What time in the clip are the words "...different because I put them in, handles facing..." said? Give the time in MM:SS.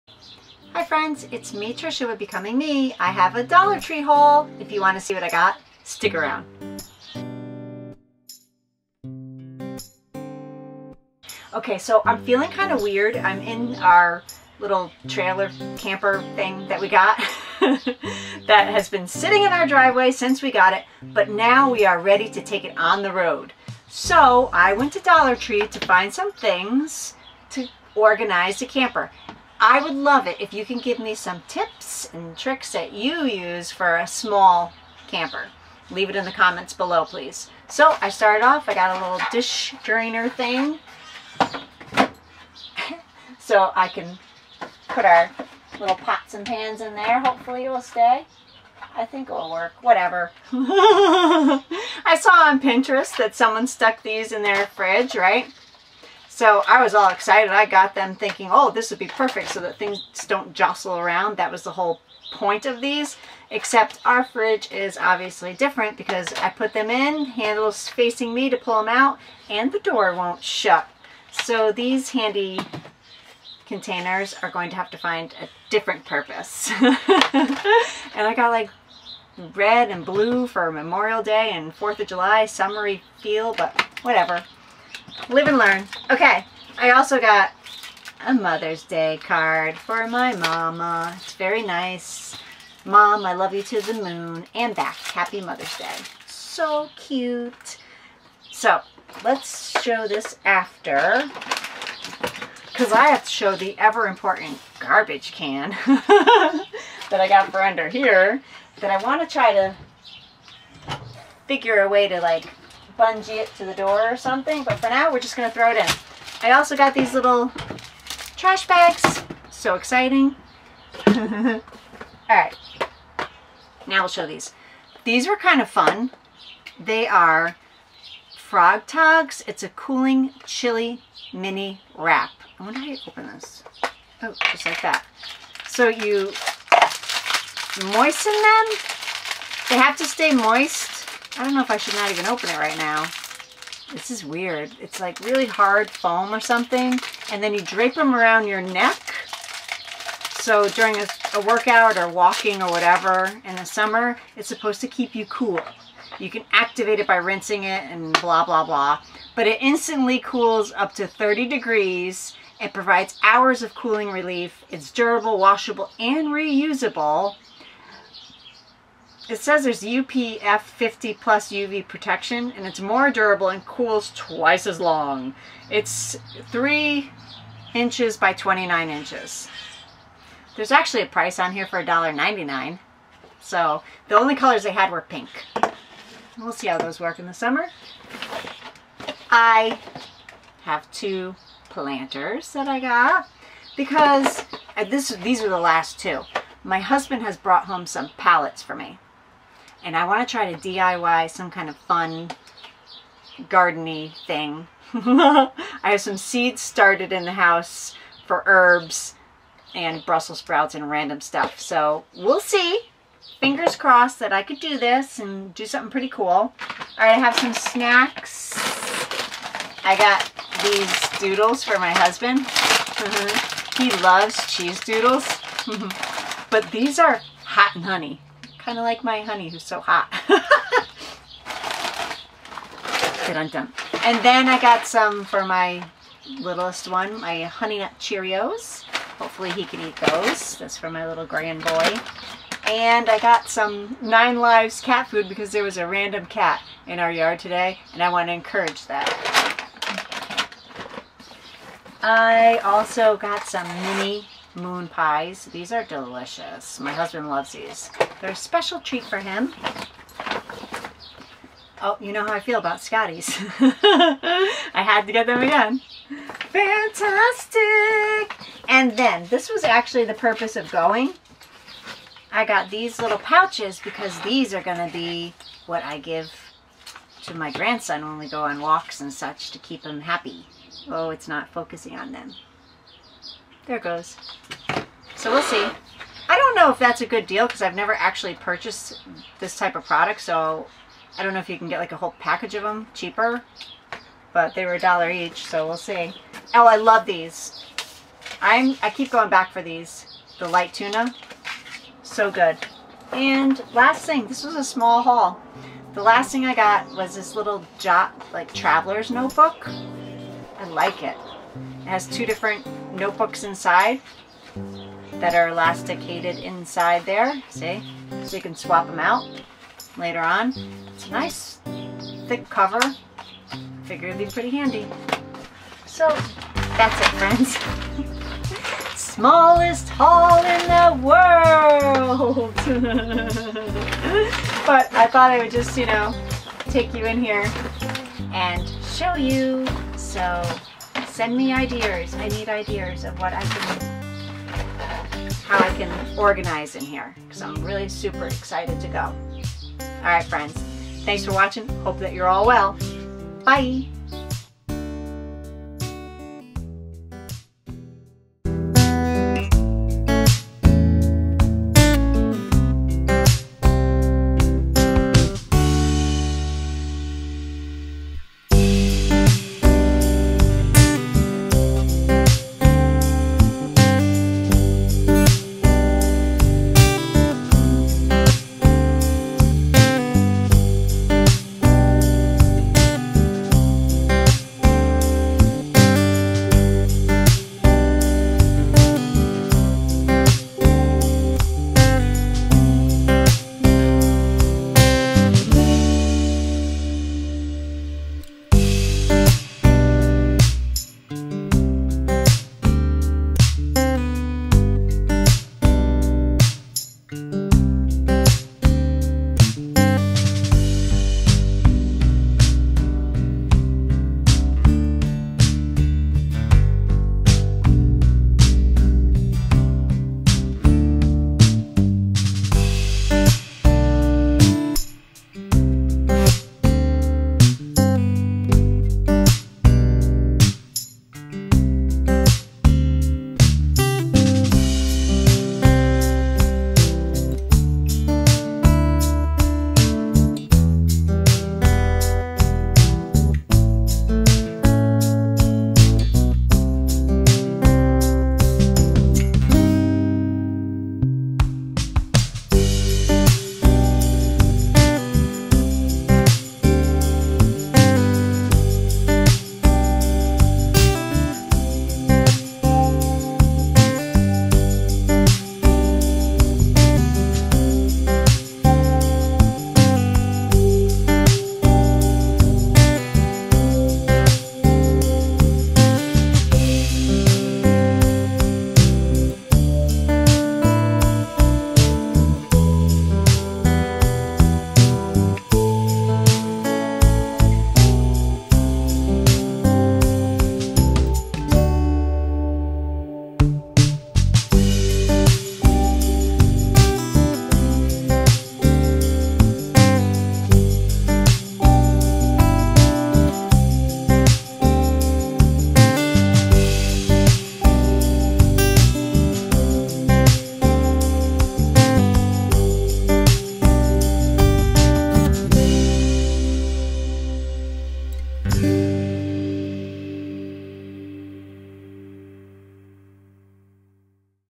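01:05.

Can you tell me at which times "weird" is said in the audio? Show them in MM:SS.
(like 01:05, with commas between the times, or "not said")
00:12, 02:24.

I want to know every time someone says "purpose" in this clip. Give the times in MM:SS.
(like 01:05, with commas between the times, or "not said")
01:16, 04:30.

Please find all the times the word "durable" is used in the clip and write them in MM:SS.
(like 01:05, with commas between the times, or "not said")
02:44, 02:53.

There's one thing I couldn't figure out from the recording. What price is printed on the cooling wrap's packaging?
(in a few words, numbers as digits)
$1.99.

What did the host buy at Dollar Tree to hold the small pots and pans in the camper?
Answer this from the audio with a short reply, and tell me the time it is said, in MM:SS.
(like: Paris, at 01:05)
dish drainer, at 00:39.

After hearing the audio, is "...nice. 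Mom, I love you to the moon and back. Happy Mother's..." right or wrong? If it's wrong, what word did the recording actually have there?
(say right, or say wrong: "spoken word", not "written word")
right.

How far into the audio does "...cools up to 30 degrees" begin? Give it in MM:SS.
02:40.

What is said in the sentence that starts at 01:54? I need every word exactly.
But for now, we're just going to throw it in.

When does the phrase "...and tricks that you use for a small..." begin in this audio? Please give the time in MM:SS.
00:32.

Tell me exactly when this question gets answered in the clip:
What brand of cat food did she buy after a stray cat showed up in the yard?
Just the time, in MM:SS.
04:04.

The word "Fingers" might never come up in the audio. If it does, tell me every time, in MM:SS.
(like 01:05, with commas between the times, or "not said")
03:33.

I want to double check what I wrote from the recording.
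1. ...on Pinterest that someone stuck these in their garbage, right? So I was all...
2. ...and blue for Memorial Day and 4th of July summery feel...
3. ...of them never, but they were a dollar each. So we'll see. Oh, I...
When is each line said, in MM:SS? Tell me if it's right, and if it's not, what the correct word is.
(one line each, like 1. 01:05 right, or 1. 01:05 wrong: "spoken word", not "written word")
1. 00:52 wrong: "fridge", not "garbage"
2. 01:19 right
3. 04:52 wrong: "cheaper", not "never".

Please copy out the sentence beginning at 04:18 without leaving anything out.
They're a special treat for him.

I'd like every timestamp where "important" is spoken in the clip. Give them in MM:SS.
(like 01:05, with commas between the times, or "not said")
01:44.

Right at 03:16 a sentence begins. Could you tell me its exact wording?
My husband has brought home some pallets for me and I want to try to DIY some kind of fun gardeny thing.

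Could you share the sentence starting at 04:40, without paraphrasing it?
Oh, it's not focusing on them.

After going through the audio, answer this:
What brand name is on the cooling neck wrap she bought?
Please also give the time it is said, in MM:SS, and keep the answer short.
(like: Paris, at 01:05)
Frogg Toggs, at 02:08.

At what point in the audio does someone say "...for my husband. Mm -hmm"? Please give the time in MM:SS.
03:41.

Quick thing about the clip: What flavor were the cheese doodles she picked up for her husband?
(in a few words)
hot and honey.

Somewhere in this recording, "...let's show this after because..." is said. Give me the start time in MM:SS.
01:39.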